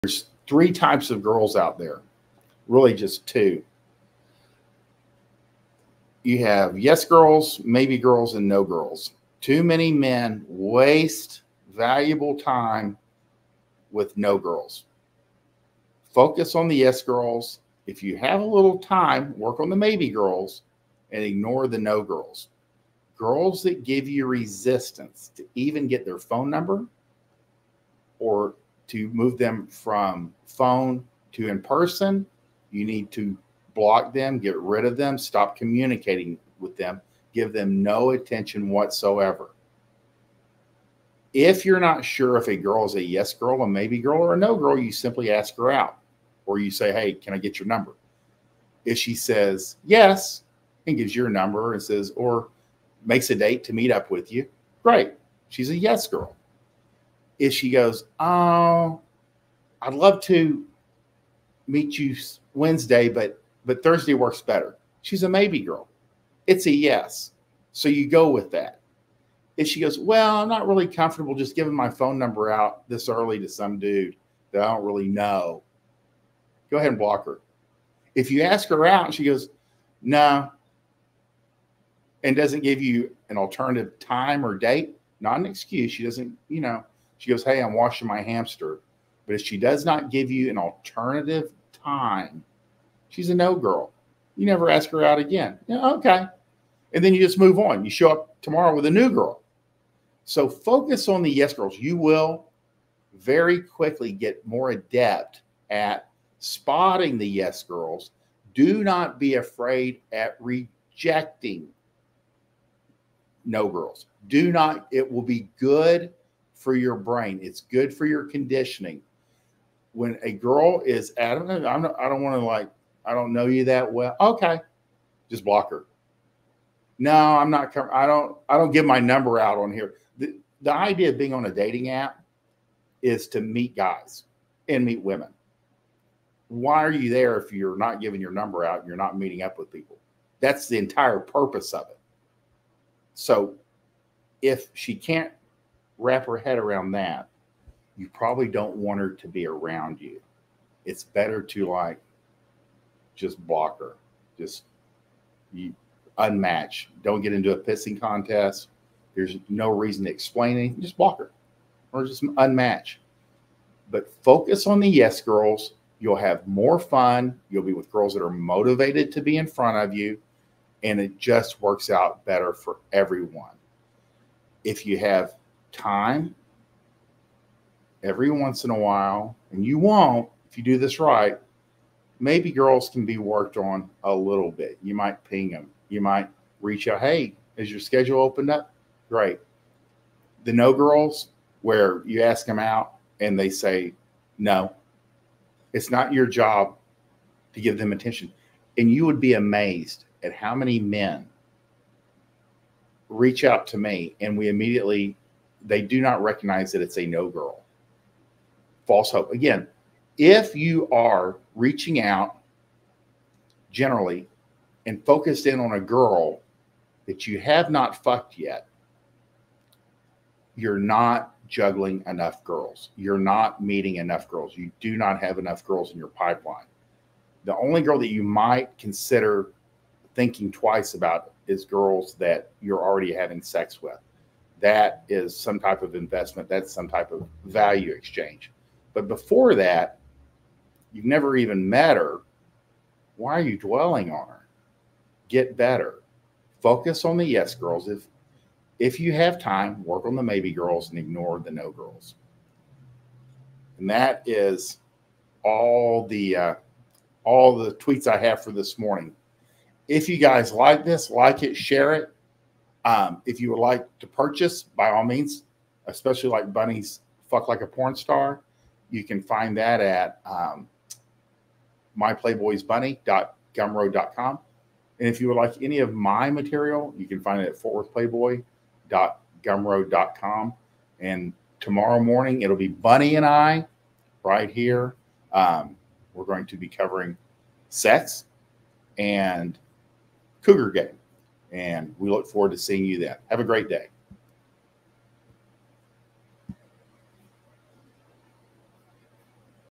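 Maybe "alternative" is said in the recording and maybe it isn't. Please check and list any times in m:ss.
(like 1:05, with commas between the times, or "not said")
1:23, 1:30.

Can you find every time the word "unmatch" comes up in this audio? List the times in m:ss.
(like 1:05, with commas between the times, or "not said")
2:36, 2:42.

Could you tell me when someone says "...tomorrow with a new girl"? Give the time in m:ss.
1:38.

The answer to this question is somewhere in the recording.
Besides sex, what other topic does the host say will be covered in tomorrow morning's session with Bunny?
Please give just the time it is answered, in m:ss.
4:50.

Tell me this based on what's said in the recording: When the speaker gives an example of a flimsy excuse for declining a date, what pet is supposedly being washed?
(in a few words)
hamster.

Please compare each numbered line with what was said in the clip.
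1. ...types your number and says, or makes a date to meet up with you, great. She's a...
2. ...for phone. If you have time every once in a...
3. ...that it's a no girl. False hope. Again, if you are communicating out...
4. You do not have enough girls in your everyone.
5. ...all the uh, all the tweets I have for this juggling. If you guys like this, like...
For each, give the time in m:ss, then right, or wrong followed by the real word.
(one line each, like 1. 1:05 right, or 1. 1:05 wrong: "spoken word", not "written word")
1. 0:50 wrong: "gives", not "types"
2. 2:52 wrong: "everyone", not "phone"
3. 3:26 wrong: "reaching", not "communicating"
4. 3:44 wrong: "pipeline", not "everyone"
5. 4:15 wrong: "morning", not "juggling".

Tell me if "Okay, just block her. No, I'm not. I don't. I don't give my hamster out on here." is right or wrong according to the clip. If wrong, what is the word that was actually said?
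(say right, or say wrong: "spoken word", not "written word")
wrong: "number", not "hamster".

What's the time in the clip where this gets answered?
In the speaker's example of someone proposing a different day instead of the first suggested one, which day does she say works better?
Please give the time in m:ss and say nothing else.
1:03.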